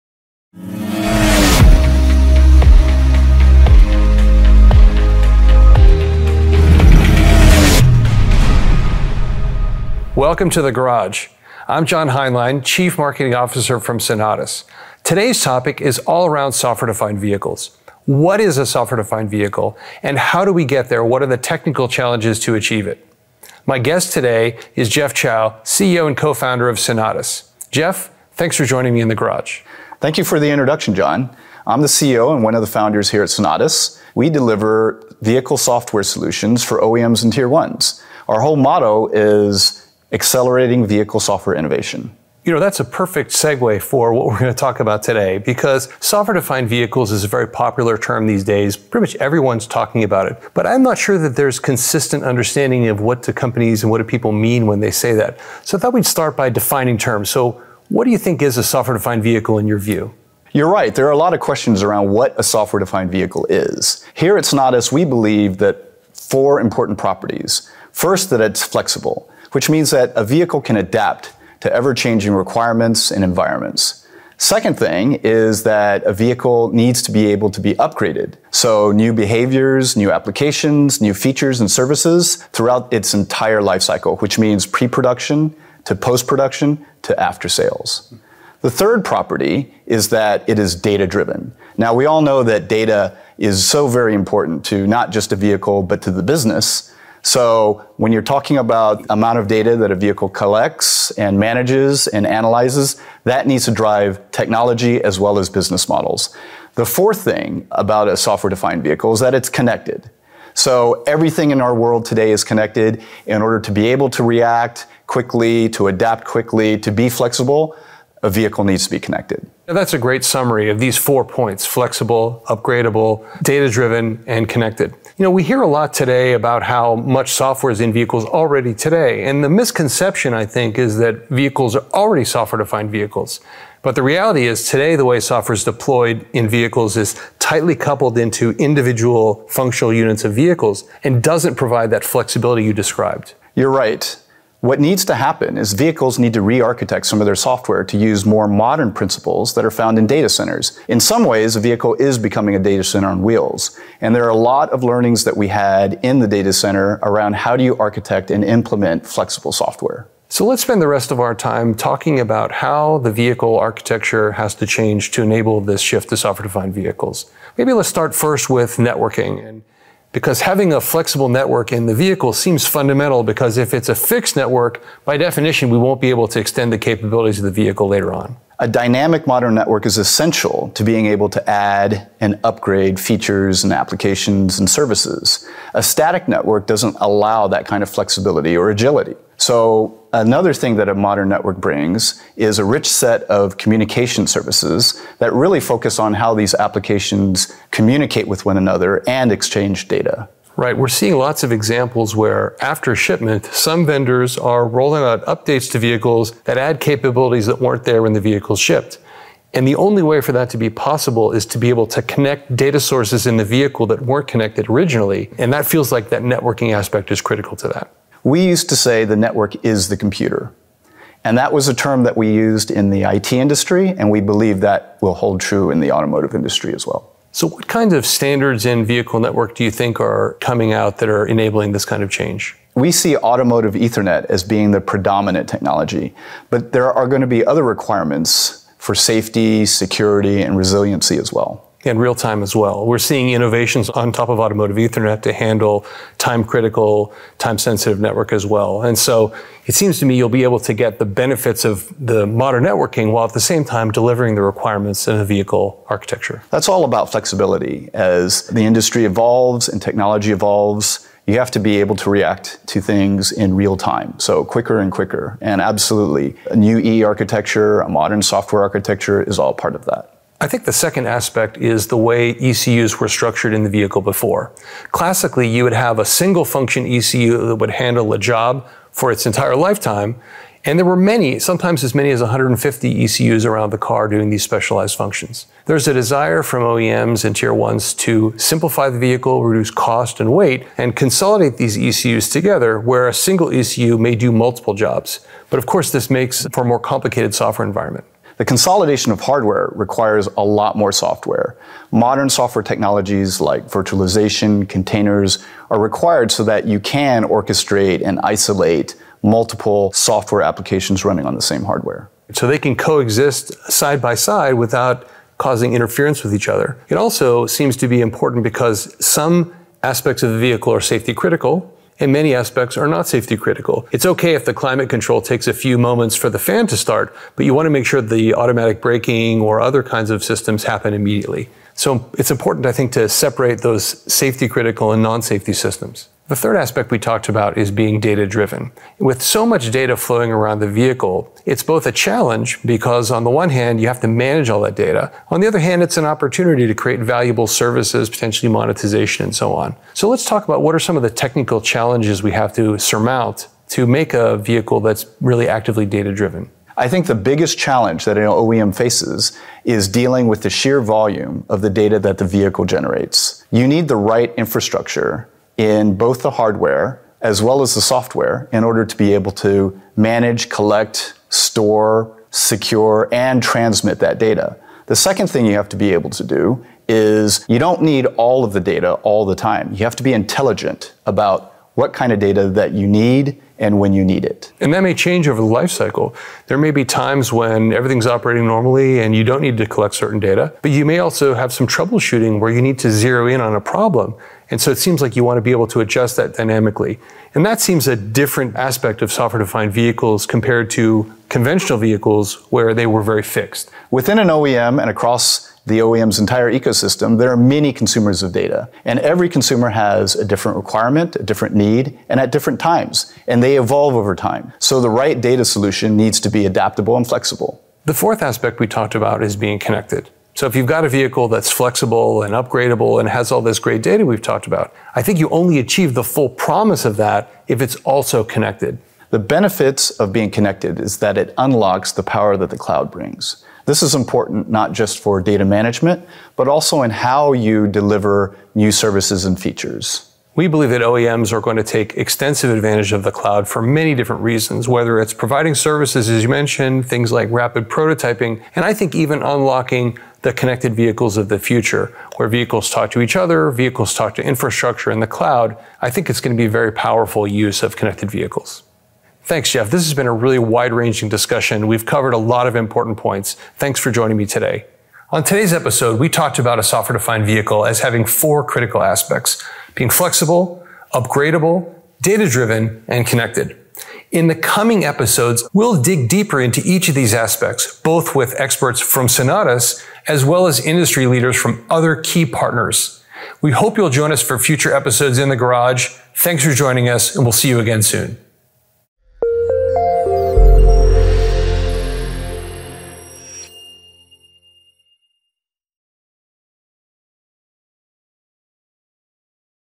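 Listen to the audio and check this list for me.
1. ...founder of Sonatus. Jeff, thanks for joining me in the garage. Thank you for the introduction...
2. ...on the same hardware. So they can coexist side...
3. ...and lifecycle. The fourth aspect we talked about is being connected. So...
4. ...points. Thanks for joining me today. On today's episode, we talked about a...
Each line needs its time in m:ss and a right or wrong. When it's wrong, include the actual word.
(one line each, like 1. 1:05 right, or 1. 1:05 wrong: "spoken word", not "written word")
1. 0:26 right
2. 5:11 right
3. 6:56 wrong: "flexible", not "lifecycle"
4. 7:42 right.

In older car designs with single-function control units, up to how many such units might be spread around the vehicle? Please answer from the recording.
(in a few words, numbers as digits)
150.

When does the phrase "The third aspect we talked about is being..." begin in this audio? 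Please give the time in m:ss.
5:36.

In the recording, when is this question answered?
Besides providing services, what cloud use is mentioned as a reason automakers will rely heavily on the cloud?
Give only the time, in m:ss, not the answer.
7:27.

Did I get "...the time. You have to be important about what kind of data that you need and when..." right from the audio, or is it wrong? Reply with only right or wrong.
wrong.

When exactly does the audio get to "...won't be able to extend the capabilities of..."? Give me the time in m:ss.
2:55.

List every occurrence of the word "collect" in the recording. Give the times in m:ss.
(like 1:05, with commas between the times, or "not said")
1:40, 6:10, 6:29.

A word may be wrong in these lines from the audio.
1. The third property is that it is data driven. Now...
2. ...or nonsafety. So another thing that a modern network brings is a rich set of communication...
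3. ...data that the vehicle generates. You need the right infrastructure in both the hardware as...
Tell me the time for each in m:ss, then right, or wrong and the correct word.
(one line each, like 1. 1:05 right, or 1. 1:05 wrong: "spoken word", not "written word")
1. 1:28 right
2. 3:08 wrong: "agility", not "nonsafety"
3. 6:01 right.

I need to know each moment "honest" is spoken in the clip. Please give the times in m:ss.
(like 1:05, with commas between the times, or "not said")
not said.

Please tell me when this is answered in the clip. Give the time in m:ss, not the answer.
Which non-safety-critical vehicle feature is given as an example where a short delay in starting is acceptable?
5:24.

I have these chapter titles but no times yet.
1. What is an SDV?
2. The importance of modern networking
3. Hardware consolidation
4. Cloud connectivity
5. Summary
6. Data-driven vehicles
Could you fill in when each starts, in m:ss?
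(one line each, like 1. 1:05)
1. 1:00
2. 2:48
3. 4:30
4. 6:58
5. 7:38
6. 5:36.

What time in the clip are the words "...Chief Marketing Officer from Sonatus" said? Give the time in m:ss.
0:12.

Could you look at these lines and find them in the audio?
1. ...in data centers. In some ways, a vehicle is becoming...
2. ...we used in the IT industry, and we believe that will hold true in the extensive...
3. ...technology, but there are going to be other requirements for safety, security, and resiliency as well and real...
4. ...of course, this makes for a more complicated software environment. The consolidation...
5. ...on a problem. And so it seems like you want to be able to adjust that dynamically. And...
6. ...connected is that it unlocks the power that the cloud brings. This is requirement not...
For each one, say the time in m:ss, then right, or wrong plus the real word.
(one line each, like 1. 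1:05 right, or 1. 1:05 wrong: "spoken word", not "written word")
1. 2:29 right
2. 3:42 wrong: "automotive", not "extensive"
3. 3:55 right
4. 4:55 right
5. 6:33 right
6. 7:10 wrong: "important", not "requirement".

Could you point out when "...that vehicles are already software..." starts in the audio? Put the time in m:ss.
2:10.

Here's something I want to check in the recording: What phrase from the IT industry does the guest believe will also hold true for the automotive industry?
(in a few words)
The network is the computer.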